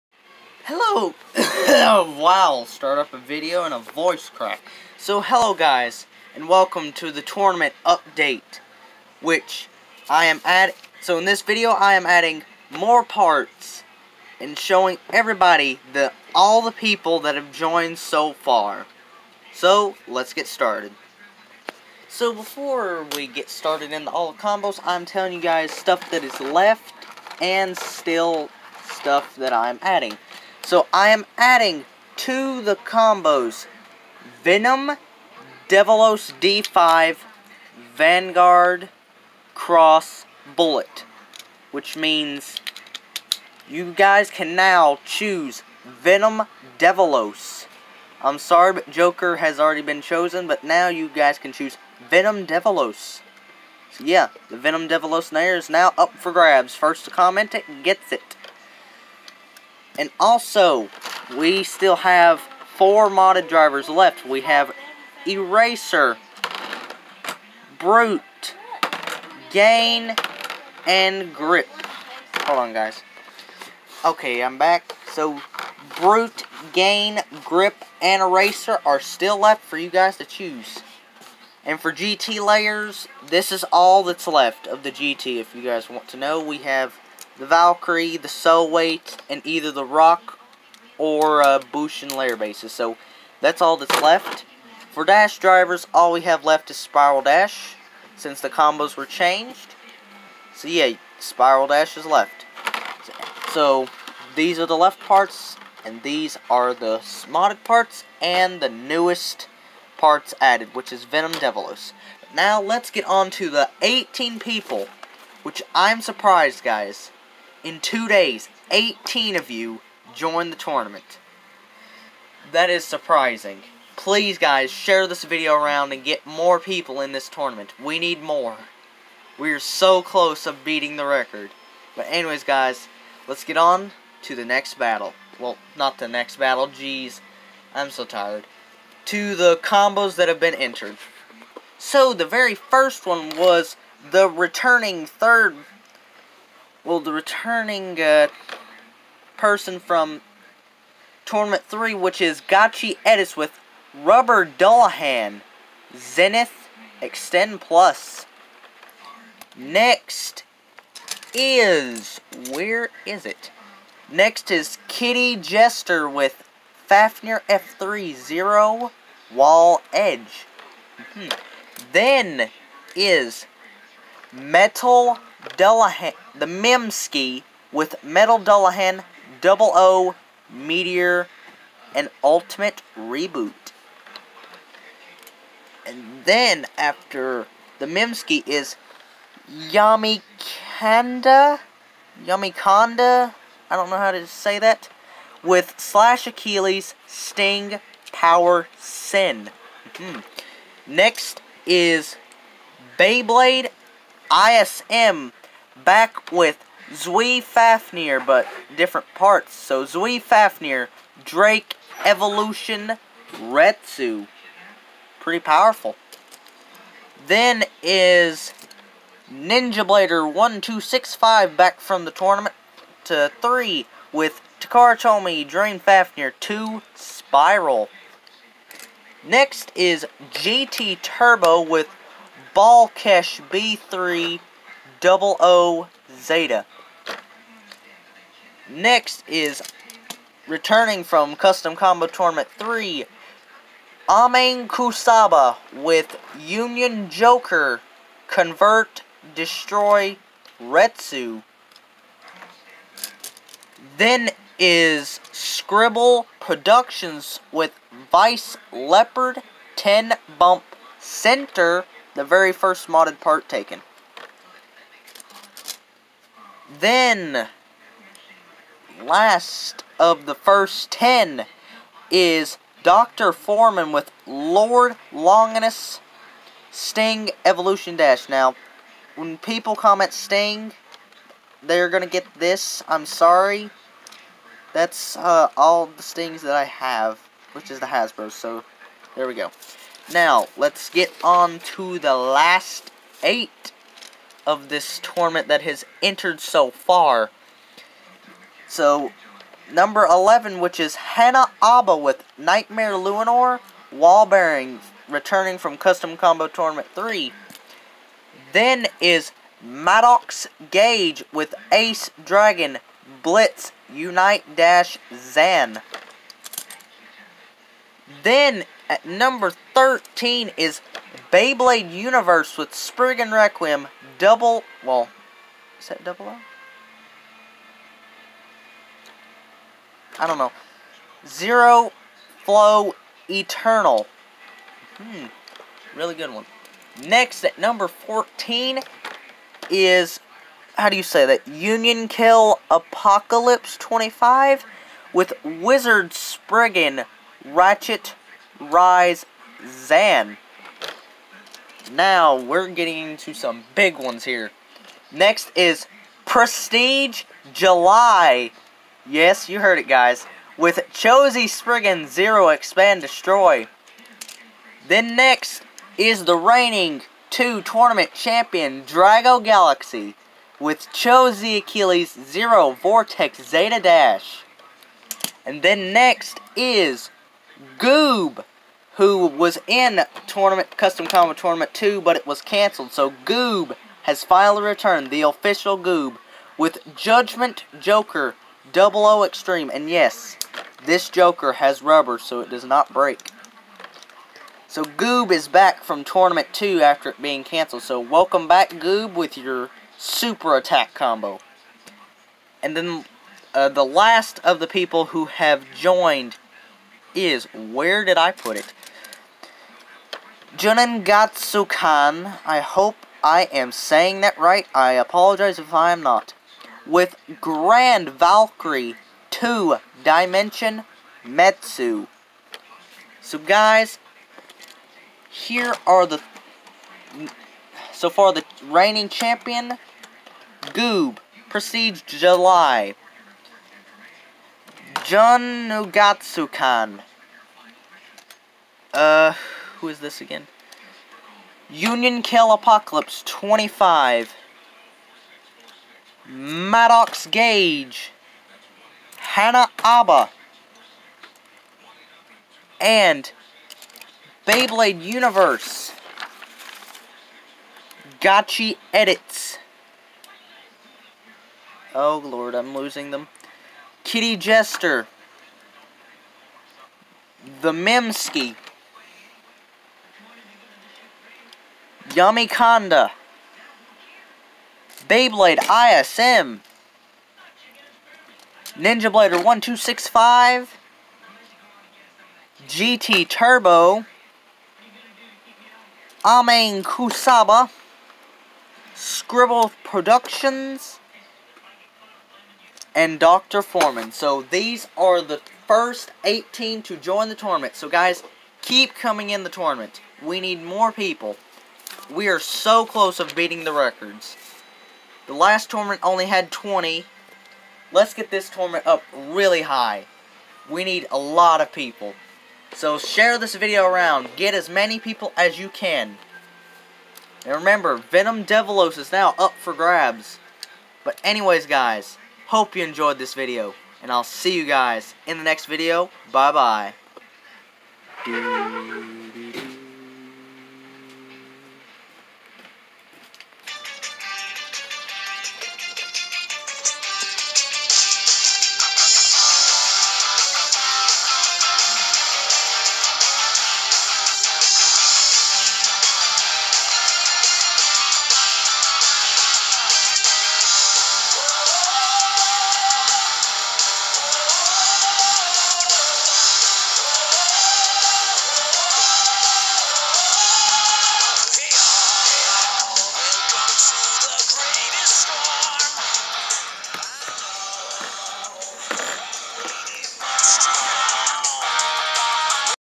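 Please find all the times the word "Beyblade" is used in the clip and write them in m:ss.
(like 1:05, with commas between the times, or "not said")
3:22, 5:21, 7:34, 7:55.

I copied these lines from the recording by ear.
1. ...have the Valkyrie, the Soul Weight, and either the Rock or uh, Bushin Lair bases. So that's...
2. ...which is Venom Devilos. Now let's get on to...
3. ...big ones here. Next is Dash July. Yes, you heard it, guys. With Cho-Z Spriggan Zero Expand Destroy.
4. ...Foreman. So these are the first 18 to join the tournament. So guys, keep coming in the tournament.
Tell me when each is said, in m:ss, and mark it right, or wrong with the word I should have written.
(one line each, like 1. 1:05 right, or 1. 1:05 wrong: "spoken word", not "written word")
1. 1:26 right
2. 1:50 right
3. 5:53 wrong: "Prestige", not "Dash"
4. 8:13 right.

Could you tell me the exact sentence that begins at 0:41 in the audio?
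Which means you guys can now choose Venom Devilos.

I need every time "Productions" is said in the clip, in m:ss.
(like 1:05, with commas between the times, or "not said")
4:16, 8:09.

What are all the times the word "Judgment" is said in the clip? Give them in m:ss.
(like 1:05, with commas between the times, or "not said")
6:26.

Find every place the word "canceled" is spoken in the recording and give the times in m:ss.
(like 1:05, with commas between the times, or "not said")
6:22, 6:37.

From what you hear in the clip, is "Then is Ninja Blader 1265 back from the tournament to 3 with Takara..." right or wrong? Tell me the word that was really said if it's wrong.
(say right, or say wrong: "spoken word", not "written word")
right.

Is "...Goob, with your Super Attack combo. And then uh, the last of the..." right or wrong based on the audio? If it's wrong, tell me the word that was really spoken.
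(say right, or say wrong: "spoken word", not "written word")
right.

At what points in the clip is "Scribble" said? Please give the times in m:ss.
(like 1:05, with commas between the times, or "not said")
4:15, 8:08.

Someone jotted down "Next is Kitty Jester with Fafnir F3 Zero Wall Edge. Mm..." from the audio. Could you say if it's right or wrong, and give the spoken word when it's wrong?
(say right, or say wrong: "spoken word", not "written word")
right.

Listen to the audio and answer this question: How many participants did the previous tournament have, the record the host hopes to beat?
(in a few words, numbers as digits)
20.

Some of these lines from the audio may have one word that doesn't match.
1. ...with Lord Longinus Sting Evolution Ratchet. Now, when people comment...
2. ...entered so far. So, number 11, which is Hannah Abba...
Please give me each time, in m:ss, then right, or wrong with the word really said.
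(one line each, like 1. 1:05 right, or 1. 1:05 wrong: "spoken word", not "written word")
1. 4:33 wrong: "Dash", not "Ratchet"
2. 4:56 right.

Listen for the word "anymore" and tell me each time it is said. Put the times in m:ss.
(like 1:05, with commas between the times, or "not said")
not said.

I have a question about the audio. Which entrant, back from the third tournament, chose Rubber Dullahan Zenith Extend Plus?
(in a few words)
Gachi Edis.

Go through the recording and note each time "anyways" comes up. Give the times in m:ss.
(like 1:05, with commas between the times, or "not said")
2:12, 8:41.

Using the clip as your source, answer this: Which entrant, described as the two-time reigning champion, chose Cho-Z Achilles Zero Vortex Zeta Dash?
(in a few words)
Drago Galaxy.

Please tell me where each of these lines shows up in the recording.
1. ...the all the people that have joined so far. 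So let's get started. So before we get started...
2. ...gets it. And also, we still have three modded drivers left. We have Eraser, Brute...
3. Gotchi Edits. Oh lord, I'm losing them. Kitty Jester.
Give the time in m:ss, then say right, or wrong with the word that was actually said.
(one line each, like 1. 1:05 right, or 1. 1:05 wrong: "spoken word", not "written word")
1. 0:15 right
2. 0:57 wrong: "four", not "three"
3. 7:38 right.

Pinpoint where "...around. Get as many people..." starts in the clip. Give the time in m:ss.
8:33.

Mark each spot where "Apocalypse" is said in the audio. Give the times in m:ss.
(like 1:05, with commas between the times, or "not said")
5:42, 7:22.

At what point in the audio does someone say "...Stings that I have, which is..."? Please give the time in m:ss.
4:46.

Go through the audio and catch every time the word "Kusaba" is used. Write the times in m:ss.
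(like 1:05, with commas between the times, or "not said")
4:04, 8:06.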